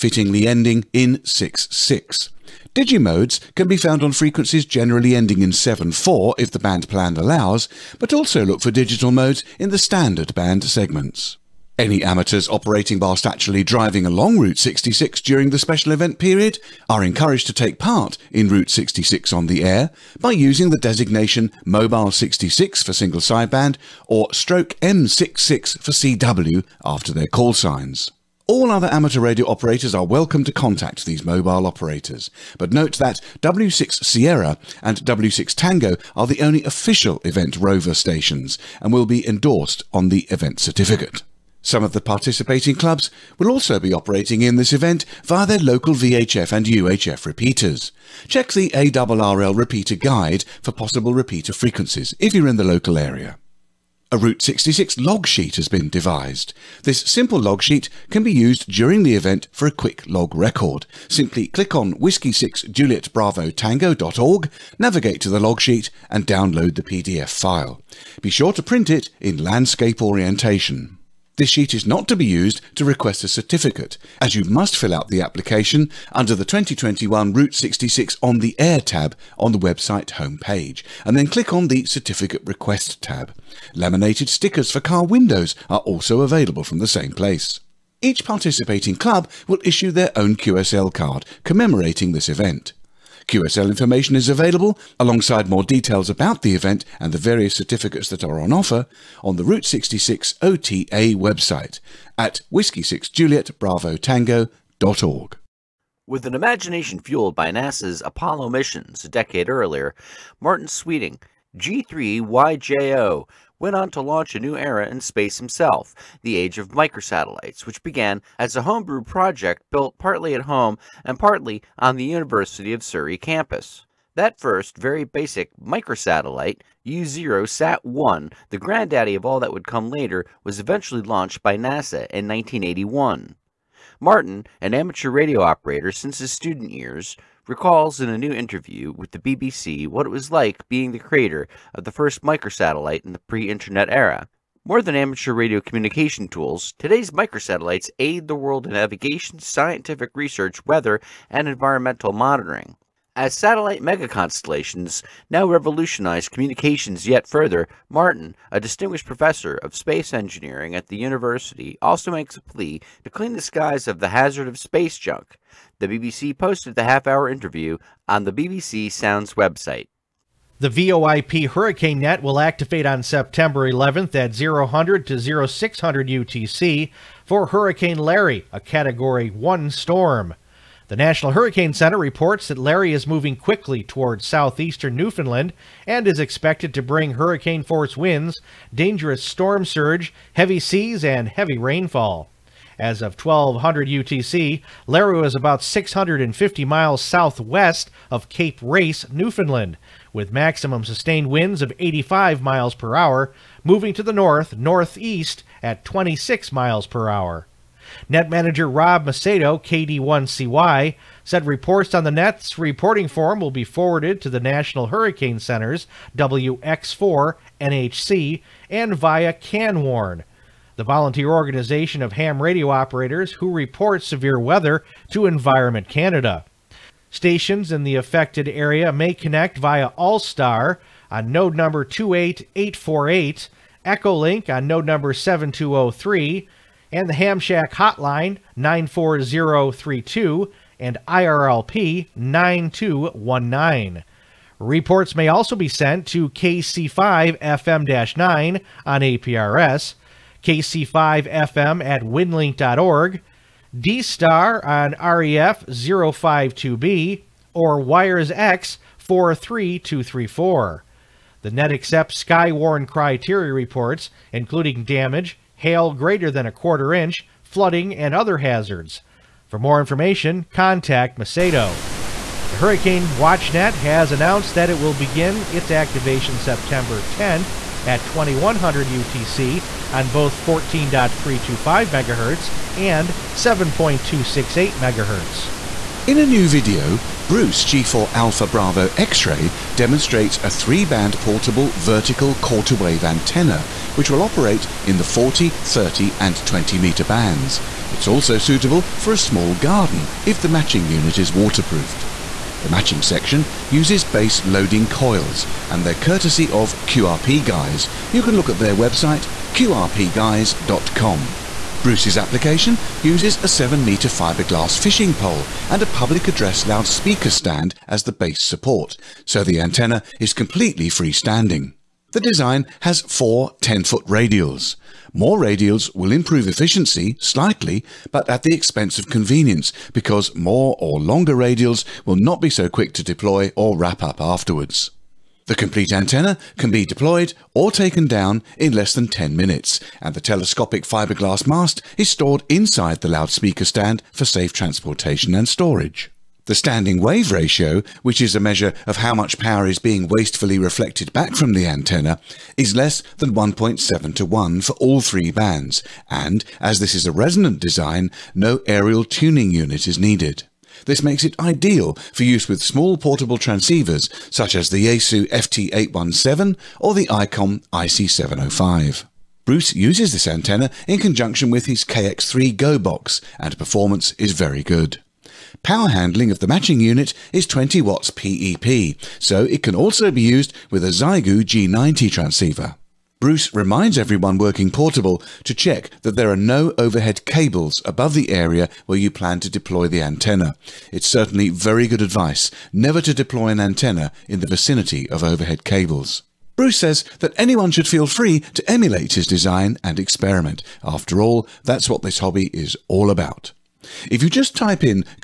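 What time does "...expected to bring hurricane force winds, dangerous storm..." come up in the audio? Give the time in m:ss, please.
3:06.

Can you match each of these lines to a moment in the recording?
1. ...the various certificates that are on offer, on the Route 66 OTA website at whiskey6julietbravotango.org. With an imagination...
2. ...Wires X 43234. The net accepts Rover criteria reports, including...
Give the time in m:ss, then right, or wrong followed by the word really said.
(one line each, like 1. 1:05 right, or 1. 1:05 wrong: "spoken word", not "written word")
1. 1:37 right
2. 4:17 wrong: "Skywarn", not "Rover".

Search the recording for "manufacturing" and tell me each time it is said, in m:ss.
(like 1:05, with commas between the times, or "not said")
not said.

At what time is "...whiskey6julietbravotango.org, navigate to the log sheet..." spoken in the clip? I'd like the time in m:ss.
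1:01.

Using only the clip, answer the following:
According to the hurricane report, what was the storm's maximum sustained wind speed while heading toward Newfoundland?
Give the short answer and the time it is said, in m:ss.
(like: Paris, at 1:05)
85 mph, at 3:21.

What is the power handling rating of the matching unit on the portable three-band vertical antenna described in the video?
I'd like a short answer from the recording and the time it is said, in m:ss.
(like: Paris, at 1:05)
20 watts PEP, at 6:17.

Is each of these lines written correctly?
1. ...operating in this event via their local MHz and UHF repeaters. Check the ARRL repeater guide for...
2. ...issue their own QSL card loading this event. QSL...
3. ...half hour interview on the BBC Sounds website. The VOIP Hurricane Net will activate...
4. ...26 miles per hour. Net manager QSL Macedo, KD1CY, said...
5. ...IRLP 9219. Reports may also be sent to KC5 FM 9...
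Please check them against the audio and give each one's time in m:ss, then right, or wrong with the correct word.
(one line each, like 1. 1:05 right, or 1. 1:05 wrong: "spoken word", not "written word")
1. 0:43 wrong: "VHF", not "MHz"
2. 1:29 wrong: "commemorating", not "loading"
3. 2:46 right
4. 3:25 wrong: "Rob", not "QSL"
5. 4:01 right.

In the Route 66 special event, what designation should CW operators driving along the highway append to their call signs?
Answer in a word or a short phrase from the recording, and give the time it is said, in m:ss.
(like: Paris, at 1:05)
/M66, at 0:24.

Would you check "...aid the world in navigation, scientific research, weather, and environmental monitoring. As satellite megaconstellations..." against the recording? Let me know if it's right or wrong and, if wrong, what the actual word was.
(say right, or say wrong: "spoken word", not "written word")
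right.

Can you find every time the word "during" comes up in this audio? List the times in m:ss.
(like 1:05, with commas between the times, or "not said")
0:15, 0:58.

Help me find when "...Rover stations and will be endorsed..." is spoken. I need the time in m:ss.
0:37.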